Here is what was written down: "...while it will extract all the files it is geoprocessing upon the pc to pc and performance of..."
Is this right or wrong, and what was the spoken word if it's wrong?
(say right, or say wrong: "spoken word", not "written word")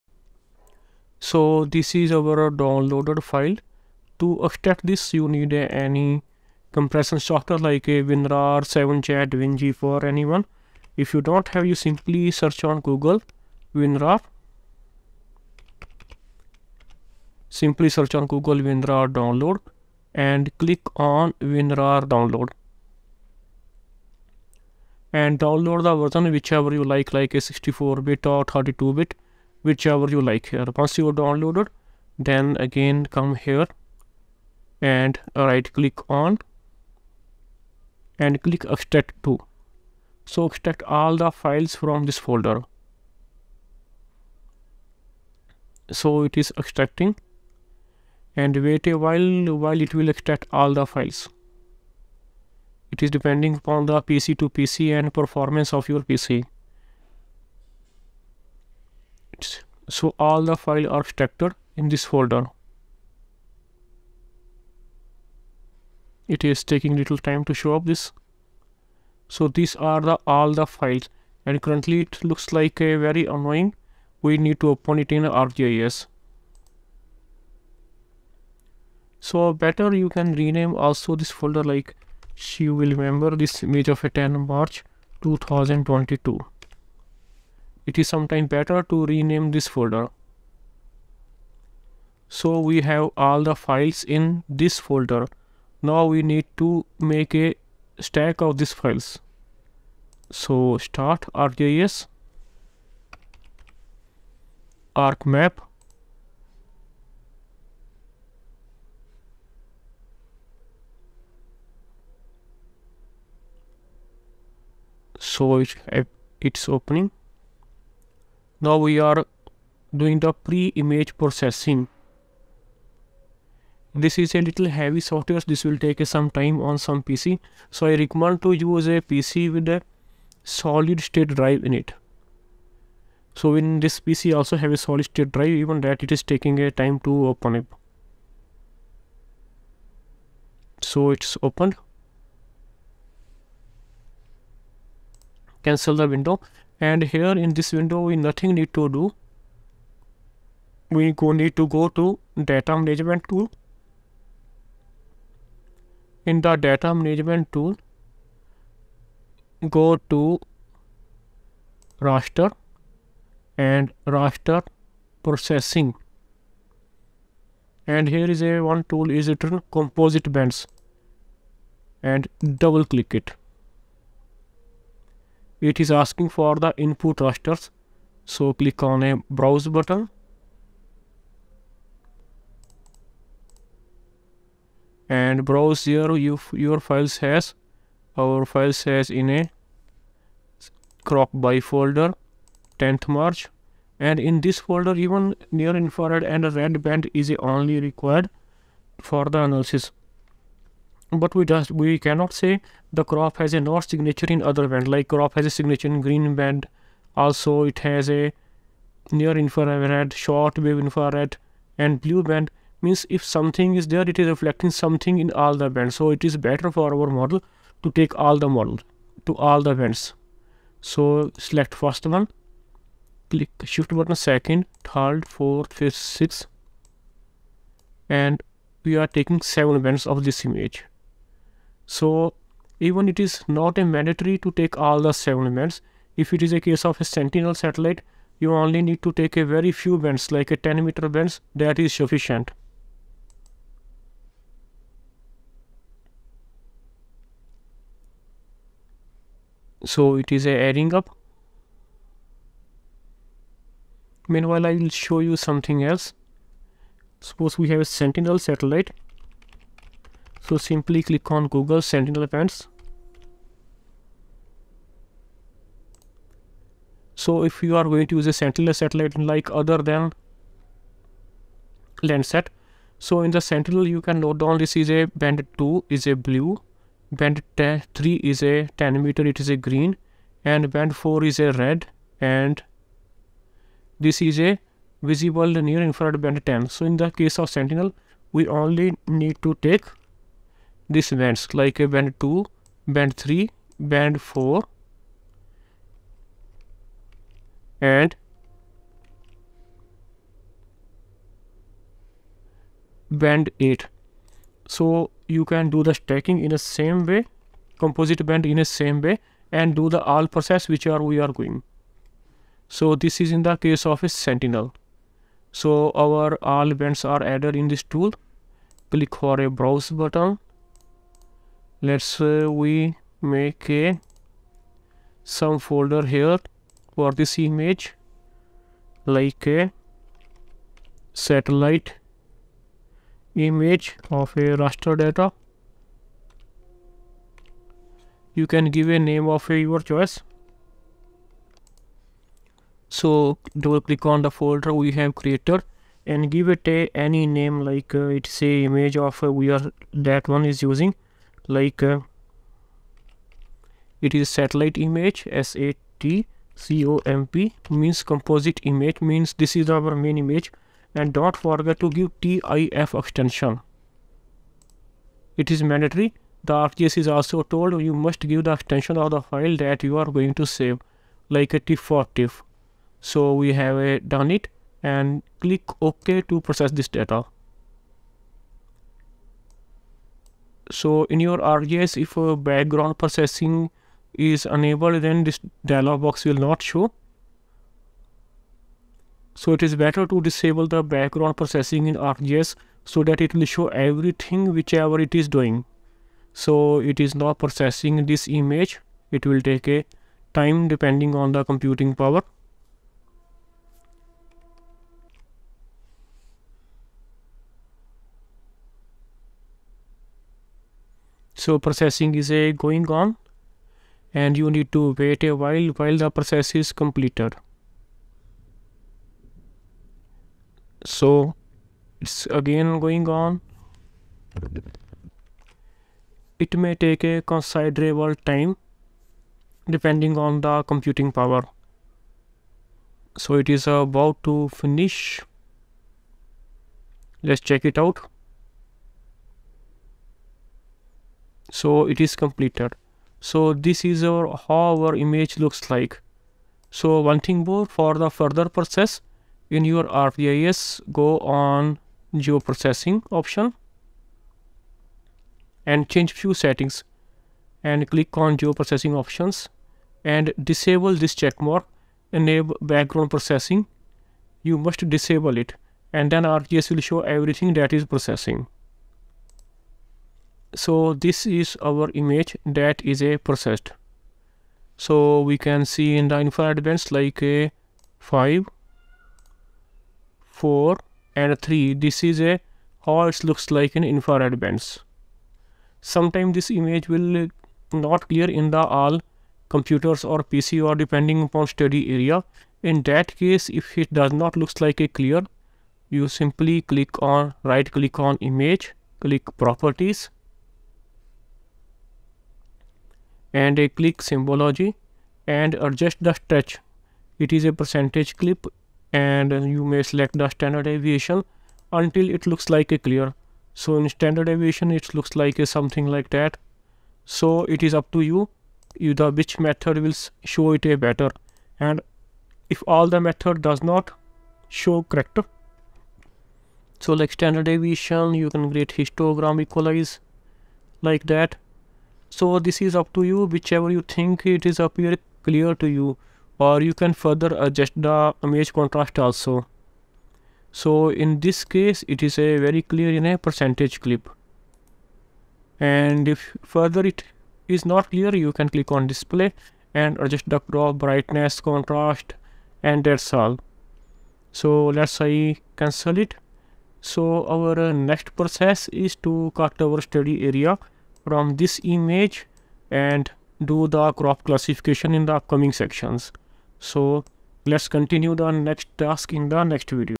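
wrong: "depending", not "geoprocessing".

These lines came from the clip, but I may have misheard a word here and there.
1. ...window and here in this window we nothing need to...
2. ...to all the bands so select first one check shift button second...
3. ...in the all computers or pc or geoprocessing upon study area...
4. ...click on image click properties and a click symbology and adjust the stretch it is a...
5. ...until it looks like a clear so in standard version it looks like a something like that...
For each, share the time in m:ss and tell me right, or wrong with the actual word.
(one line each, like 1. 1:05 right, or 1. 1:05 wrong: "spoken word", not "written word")
1. 2:26 right
2. 3:39 wrong: "click", not "check"
3. 8:08 wrong: "depending", not "geoprocessing"
4. 8:17 right
5. 8:31 wrong: "deviation", not "version".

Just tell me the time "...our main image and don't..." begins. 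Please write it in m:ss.
5:59.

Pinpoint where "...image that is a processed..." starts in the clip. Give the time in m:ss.
7:51.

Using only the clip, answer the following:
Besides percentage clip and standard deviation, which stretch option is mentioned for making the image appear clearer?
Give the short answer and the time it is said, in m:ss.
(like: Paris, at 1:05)
histogram equalize, at 8:48.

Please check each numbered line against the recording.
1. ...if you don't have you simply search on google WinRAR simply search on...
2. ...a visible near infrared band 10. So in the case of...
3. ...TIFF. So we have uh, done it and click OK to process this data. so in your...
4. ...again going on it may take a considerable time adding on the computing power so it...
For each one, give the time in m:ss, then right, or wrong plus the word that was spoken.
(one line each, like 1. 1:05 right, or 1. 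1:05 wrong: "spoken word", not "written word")
1. 0:10 right
2. 4:44 right
3. 6:12 right
4. 7:02 wrong: "depending", not "adding".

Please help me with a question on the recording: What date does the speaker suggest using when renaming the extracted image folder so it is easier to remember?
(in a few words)
10 March 2022.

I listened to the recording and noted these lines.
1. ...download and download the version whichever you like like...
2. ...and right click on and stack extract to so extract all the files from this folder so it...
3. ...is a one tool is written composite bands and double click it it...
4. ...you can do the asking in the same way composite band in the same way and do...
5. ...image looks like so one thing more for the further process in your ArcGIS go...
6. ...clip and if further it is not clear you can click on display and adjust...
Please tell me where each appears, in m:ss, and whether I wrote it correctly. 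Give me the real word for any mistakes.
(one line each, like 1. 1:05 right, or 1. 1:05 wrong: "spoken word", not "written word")
1. 0:22 right
2. 0:34 wrong: "click", not "stack"
3. 2:48 right
4. 5:05 wrong: "stacking", not "asking"
5. 7:24 right
6. 9:03 right.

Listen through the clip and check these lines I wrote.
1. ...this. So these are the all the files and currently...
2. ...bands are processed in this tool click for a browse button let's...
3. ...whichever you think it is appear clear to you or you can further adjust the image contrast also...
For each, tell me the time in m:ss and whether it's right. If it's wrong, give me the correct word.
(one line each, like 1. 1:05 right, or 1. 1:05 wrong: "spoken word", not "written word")
1. 1:07 right
2. 5:16 wrong: "added", not "processed"
3. 8:53 right.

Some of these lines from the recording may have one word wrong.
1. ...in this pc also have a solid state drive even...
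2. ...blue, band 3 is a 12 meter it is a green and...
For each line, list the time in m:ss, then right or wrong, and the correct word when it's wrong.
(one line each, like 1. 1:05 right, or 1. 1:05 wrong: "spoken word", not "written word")
1. 2:13 right
2. 4:36 wrong: "10", not "12".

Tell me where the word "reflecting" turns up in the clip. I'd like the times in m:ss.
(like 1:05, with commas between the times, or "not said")
3:34.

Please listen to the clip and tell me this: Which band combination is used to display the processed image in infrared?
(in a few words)
5 4 3.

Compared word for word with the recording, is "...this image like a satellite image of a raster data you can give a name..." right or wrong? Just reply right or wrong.
right.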